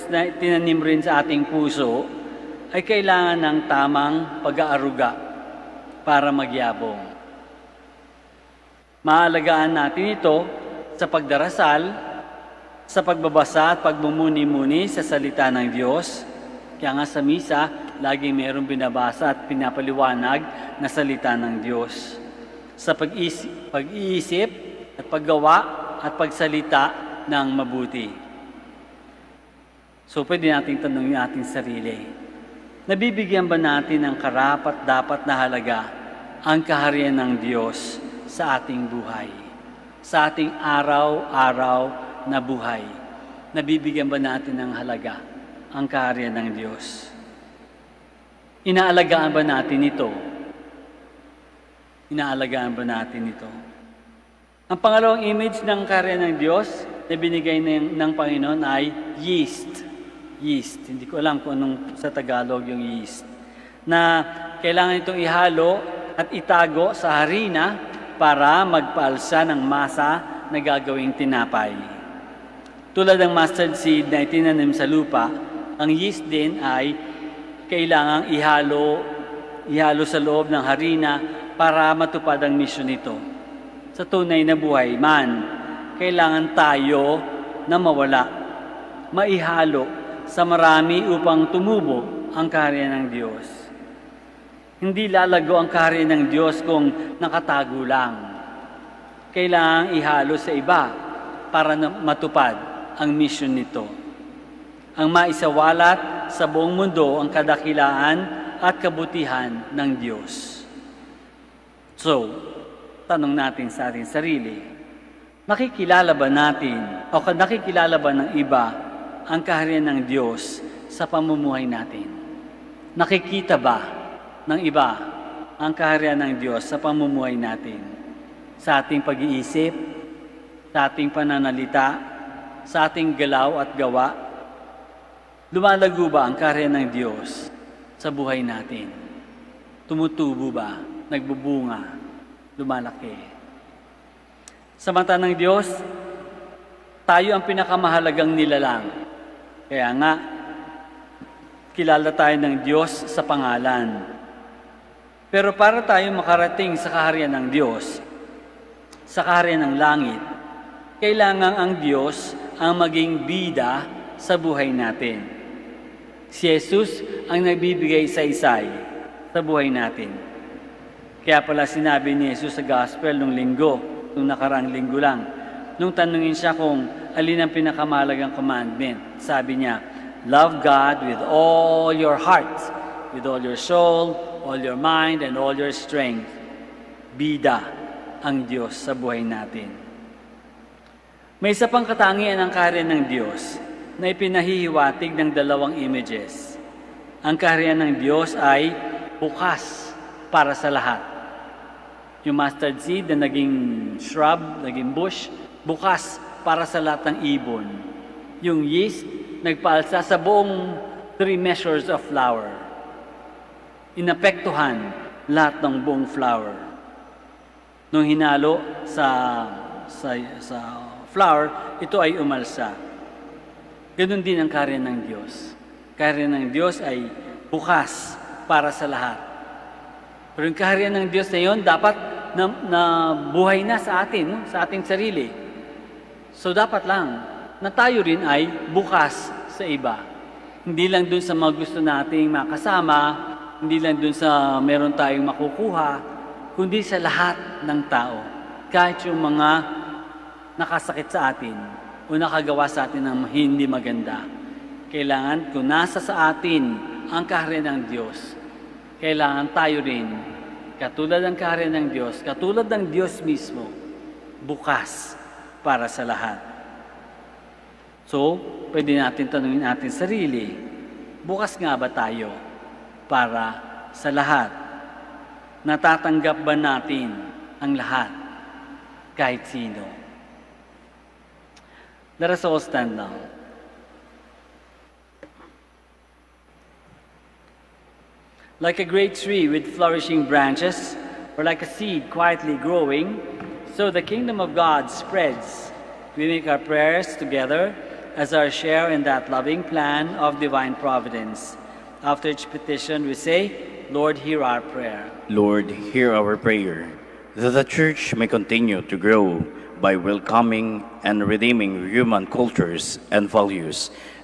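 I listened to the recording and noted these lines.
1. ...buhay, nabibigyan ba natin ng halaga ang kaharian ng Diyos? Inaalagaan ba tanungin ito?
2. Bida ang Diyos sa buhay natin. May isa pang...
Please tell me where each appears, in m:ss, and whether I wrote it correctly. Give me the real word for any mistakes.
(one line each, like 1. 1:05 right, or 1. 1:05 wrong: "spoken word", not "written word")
1. 0:42 wrong: "natin", not "tanungin"
2. 3:07 right.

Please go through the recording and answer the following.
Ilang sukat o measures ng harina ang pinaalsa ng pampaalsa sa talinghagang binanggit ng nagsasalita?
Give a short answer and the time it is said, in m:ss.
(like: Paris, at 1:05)
3, at 3:31.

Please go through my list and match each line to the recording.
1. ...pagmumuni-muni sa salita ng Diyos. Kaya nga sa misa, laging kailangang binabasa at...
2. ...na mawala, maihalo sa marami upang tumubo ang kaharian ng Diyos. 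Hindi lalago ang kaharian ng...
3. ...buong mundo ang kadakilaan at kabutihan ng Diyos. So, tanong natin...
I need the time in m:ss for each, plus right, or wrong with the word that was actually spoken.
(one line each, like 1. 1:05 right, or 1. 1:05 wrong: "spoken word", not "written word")
1. 0:13 wrong: "mayroong", not "kailangang"
2. 1:27 right
3. 1:46 right.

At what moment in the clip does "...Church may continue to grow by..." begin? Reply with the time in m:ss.
5:07.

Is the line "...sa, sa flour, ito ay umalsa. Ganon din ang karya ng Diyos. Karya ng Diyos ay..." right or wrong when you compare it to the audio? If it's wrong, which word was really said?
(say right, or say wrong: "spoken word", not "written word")
right.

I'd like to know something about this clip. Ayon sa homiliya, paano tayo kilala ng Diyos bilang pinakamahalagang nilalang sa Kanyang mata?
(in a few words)
Sa pangalan.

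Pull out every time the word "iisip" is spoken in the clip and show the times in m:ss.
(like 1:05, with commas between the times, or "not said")
0:23, 2:09.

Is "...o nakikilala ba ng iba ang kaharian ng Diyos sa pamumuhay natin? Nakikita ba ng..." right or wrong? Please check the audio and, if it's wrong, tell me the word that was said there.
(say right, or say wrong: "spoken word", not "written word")
right.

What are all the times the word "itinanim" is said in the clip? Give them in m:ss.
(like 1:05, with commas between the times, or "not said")
0:00, 1:14.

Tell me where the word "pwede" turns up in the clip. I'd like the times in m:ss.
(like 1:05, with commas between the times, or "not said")
0:30, 4:28.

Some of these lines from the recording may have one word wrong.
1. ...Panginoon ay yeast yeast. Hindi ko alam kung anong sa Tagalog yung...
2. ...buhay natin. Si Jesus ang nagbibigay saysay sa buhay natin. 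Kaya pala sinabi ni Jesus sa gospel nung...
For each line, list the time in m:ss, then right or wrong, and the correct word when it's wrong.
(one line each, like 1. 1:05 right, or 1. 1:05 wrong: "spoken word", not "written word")
1. 0:58 right
2. 2:44 right.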